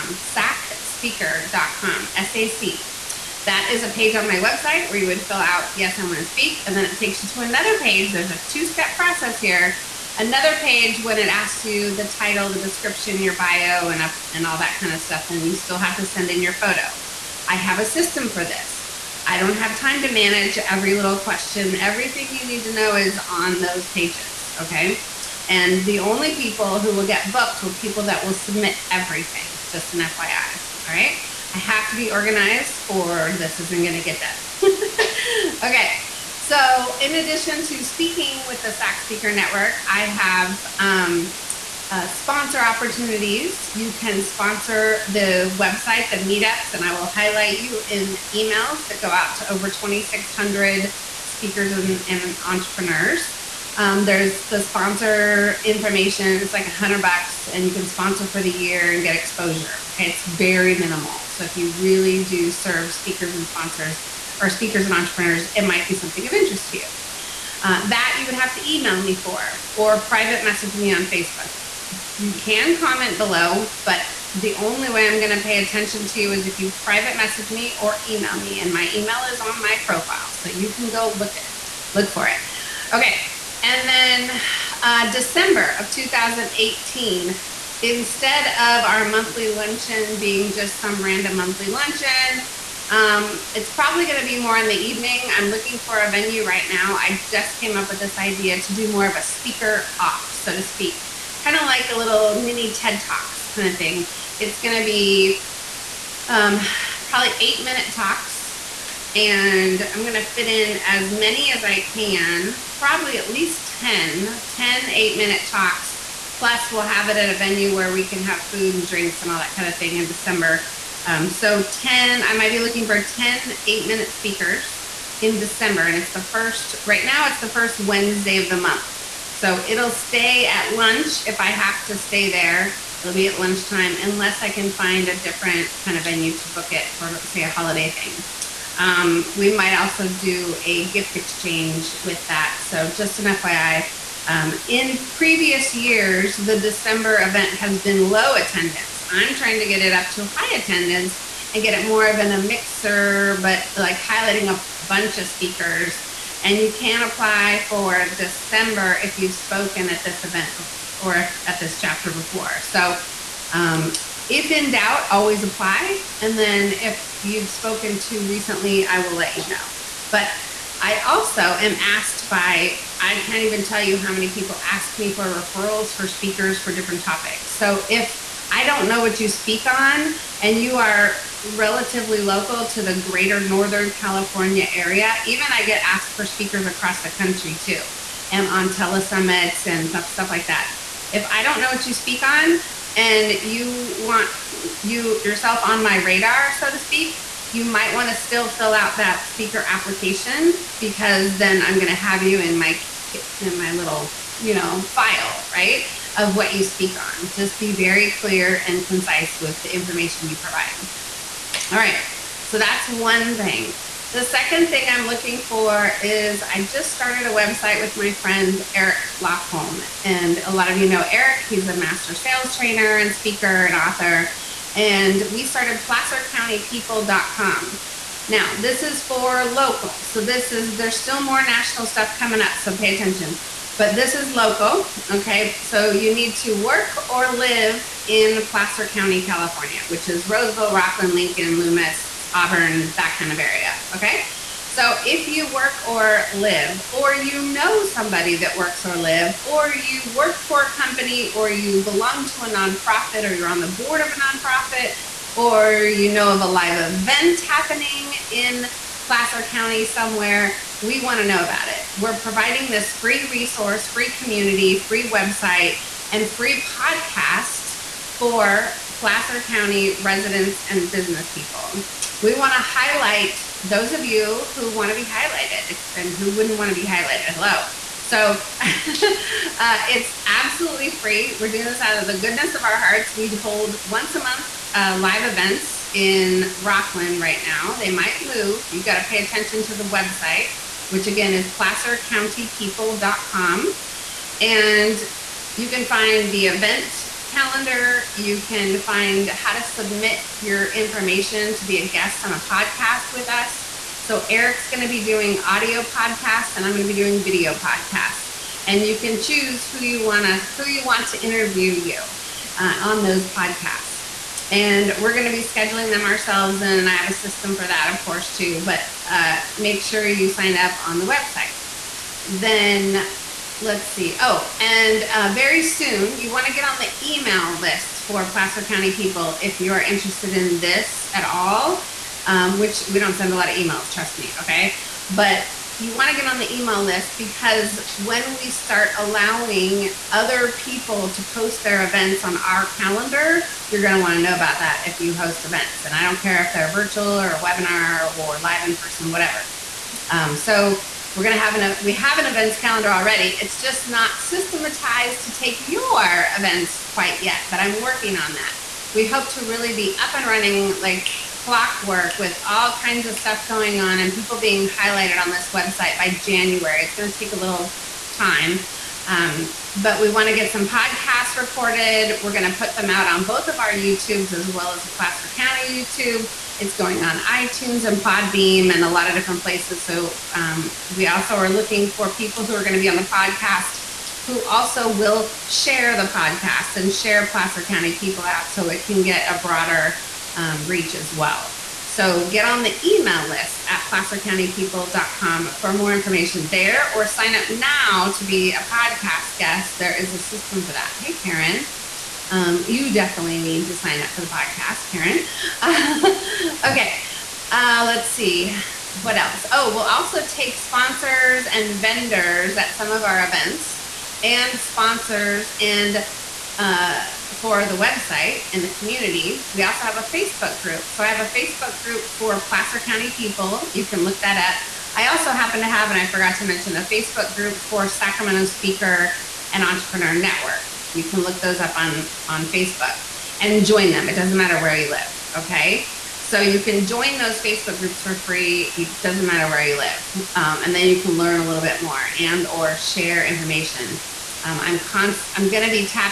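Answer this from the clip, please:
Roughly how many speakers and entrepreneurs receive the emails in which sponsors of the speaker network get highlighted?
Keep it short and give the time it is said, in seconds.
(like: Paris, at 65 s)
2,600, at 49 s.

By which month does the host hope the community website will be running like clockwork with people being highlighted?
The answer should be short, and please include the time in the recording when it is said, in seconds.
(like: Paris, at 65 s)
January, at 366 s.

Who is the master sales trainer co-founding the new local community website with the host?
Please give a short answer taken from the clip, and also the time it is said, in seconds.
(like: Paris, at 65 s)
Eric Lofholm, at 218 s.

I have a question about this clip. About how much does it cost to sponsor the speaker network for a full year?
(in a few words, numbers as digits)
$100.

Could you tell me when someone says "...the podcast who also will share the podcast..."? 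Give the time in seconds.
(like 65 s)
382 s.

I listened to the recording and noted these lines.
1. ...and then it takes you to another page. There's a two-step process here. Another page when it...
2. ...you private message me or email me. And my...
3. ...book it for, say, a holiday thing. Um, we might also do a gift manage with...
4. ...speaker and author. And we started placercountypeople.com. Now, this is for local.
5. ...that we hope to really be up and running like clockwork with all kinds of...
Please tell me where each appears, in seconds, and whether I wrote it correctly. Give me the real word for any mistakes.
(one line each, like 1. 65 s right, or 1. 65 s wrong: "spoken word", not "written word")
1. 6 s right
2. 76 s right
3. 136 s wrong: "exchange", not "manage"
4. 223 s right
5. 358 s right.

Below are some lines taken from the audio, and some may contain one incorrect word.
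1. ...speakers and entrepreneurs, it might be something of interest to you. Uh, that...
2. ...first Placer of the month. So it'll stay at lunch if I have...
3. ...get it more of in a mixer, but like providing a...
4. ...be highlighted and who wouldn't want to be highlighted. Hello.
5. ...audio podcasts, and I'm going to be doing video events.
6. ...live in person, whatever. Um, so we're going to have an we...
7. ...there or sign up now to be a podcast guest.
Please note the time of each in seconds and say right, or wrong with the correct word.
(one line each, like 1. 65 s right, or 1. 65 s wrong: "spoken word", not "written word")
1. 64 s right
2. 127 s wrong: "Wednesday", not "Placer"
3. 151 s wrong: "highlighting", not "providing"
4. 274 s right
5. 305 s wrong: "podcasts", not "events"
6. 348 s right
7. 396 s right.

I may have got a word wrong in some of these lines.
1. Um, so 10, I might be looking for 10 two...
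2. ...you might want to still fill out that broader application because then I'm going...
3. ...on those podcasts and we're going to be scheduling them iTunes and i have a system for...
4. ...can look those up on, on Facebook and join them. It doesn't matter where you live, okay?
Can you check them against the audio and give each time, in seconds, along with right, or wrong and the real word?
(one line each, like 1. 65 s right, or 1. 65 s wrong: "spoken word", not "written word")
1. 121 s wrong: "eight", not "two"
2. 197 s wrong: "speaker", not "broader"
3. 312 s wrong: "ourselves", not "iTunes"
4. 431 s right.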